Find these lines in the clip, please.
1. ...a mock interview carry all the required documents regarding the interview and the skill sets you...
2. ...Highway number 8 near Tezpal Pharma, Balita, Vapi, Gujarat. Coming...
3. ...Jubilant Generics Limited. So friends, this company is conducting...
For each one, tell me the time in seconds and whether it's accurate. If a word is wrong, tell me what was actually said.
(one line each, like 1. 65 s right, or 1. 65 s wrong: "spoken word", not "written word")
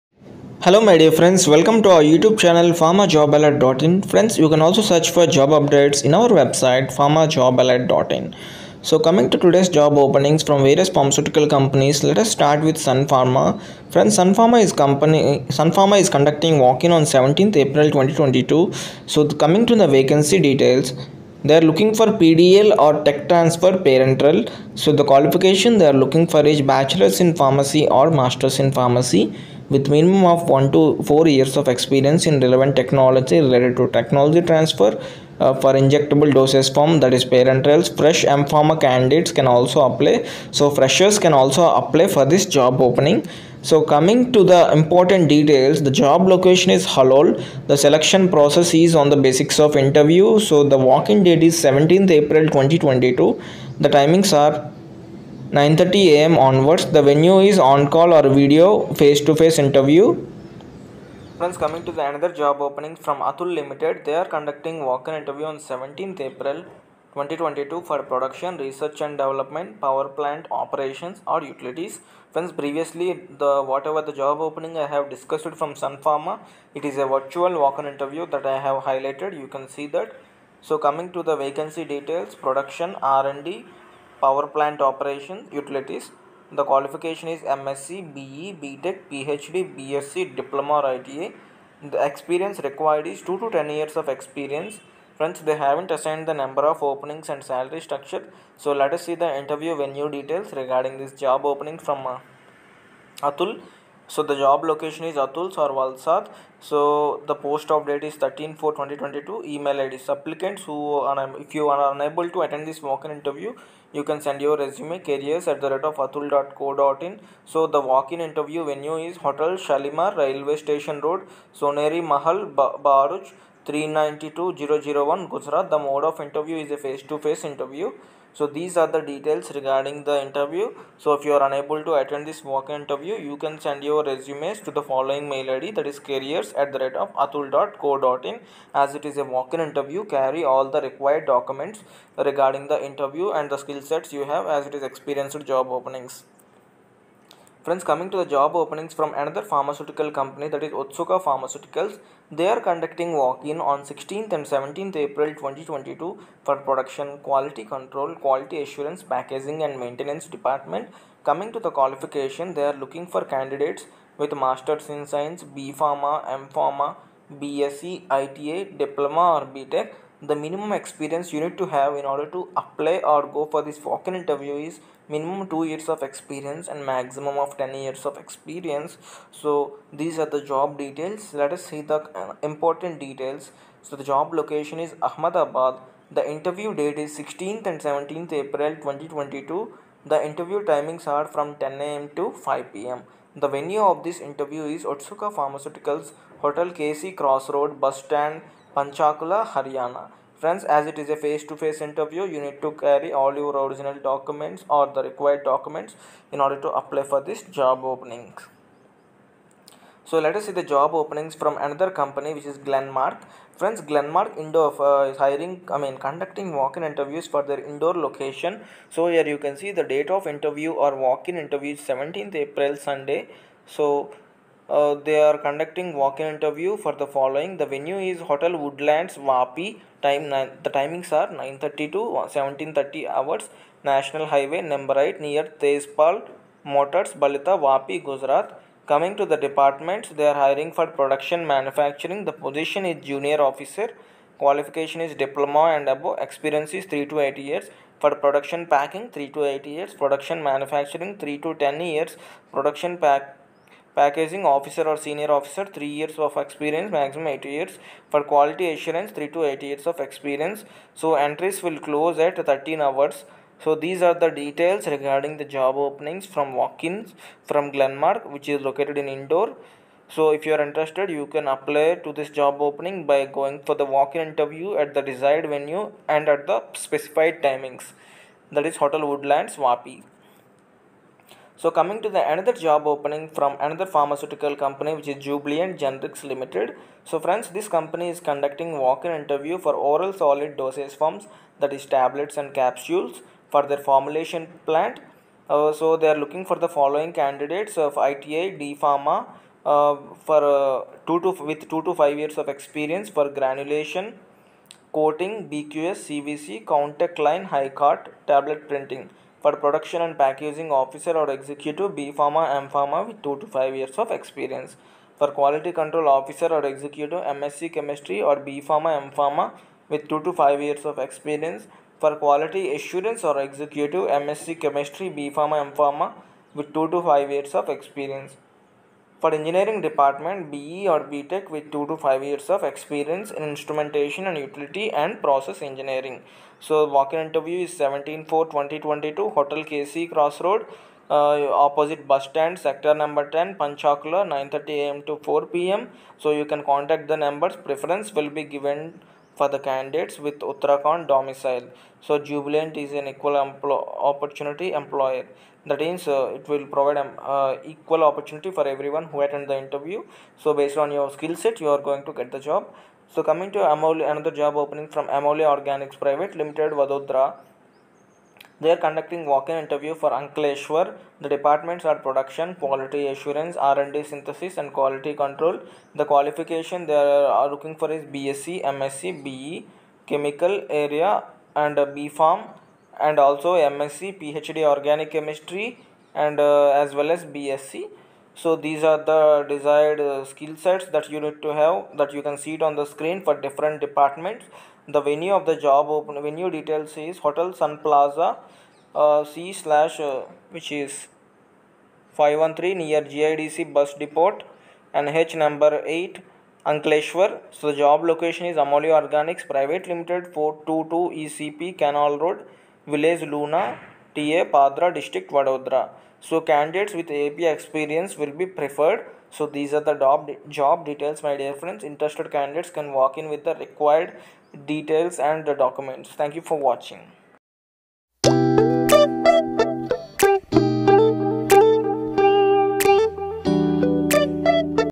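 1. 139 s right
2. 234 s wrong: "Motors", not "Pharma"
3. 285 s right.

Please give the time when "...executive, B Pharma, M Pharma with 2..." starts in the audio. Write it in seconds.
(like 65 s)
311 s.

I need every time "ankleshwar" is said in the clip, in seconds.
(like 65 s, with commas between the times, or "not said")
370 s, 406 s.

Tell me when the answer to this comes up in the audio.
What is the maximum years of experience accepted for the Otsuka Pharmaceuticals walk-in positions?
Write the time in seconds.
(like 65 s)
176 s.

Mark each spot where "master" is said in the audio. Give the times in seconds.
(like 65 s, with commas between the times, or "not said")
28 s, 164 s.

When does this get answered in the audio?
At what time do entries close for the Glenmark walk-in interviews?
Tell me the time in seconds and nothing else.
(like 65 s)
262 s.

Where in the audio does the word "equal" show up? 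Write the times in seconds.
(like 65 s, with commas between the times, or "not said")
353 s, 357 s.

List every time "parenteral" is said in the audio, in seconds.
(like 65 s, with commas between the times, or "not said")
23 s, 37 s.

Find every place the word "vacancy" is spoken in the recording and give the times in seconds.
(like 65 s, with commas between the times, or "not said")
19 s, 81 s.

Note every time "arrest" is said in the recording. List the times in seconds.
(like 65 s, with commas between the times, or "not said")
not said.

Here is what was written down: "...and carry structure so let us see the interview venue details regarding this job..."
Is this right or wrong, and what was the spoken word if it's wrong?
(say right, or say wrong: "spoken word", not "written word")
wrong: "salary", not "carry".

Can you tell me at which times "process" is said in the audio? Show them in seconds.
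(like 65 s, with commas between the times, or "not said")
48 s, 335 s.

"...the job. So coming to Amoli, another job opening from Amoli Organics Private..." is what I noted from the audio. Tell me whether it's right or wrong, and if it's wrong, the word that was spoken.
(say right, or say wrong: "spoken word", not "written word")
right.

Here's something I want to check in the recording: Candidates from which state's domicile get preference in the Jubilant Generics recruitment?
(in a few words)
Uttarakhand.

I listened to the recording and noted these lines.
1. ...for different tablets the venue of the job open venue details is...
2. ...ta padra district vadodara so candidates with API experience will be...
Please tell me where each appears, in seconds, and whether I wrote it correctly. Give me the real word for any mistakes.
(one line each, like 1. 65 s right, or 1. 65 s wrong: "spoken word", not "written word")
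1. 393 s wrong: "departments", not "tablets"
2. 414 s right.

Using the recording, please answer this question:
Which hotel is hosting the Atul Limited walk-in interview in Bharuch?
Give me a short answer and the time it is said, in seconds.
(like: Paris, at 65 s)
Hotel Shalimar, at 119 s.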